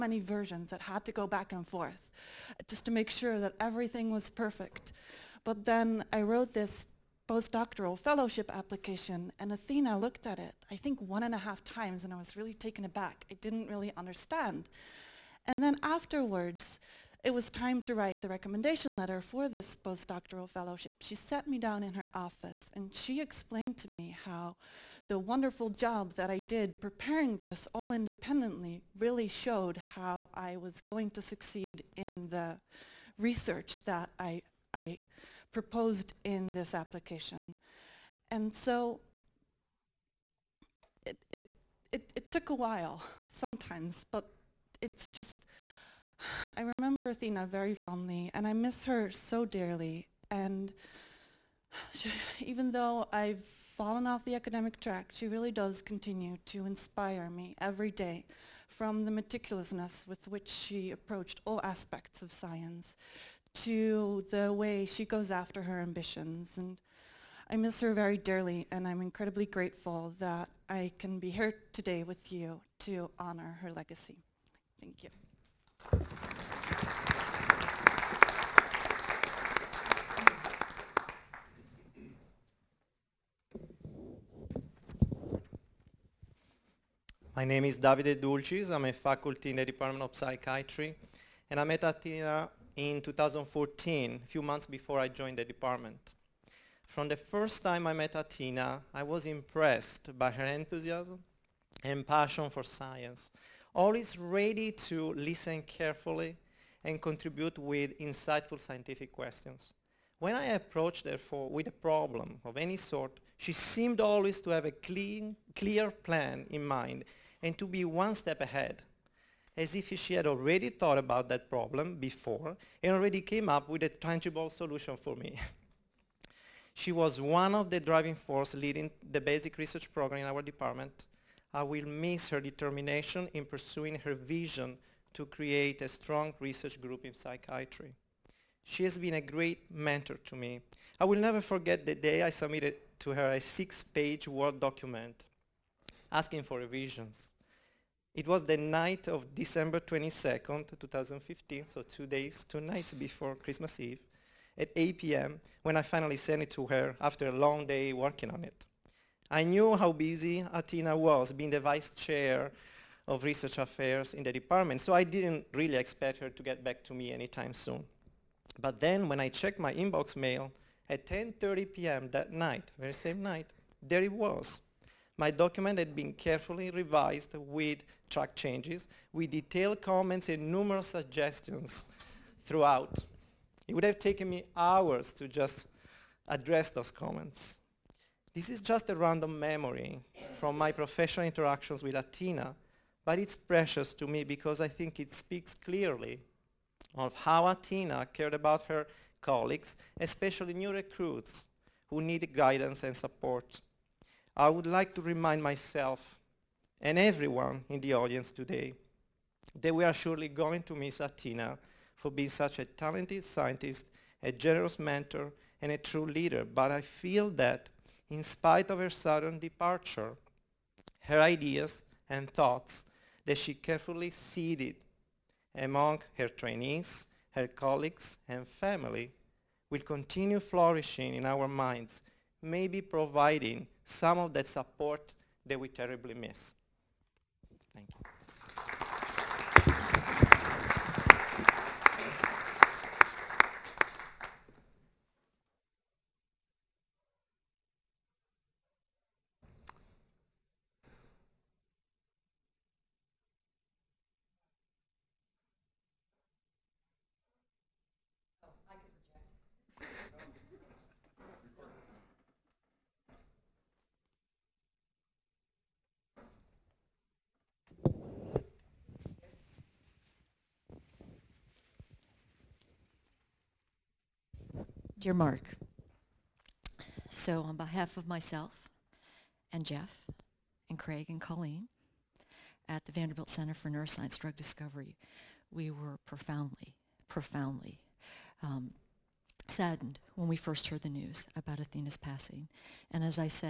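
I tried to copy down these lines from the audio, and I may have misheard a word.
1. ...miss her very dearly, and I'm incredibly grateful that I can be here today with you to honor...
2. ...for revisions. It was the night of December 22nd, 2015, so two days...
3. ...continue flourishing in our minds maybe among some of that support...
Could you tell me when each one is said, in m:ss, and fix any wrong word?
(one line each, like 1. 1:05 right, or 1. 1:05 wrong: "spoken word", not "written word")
1. 1:07 right
2. 2:26 right
3. 3:49 wrong: "providing", not "among".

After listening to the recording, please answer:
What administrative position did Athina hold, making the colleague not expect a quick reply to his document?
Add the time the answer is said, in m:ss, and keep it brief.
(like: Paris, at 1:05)
vice chair of research affairs, at 2:41.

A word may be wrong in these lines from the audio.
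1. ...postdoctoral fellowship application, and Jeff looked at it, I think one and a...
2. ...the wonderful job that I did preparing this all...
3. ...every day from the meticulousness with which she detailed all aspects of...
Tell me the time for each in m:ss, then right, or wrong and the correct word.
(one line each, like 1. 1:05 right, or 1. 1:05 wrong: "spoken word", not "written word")
1. 0:07 wrong: "Athina", not "Jeff"
2. 0:25 right
3. 0:57 wrong: "approached", not "detailed".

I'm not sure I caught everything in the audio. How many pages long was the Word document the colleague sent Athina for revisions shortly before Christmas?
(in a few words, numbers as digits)
6.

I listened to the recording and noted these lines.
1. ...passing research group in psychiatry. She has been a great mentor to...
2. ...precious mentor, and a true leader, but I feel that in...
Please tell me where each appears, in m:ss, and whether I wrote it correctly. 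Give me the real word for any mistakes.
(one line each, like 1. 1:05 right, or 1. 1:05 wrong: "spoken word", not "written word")
1. 2:15 wrong: "strong", not "passing"
2. 3:34 wrong: "generous", not "precious".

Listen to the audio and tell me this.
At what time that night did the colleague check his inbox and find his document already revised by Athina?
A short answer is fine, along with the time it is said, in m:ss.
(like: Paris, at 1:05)
10:30 p.m., at 2:51.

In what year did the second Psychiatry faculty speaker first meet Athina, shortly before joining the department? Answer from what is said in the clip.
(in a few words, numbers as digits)
2014.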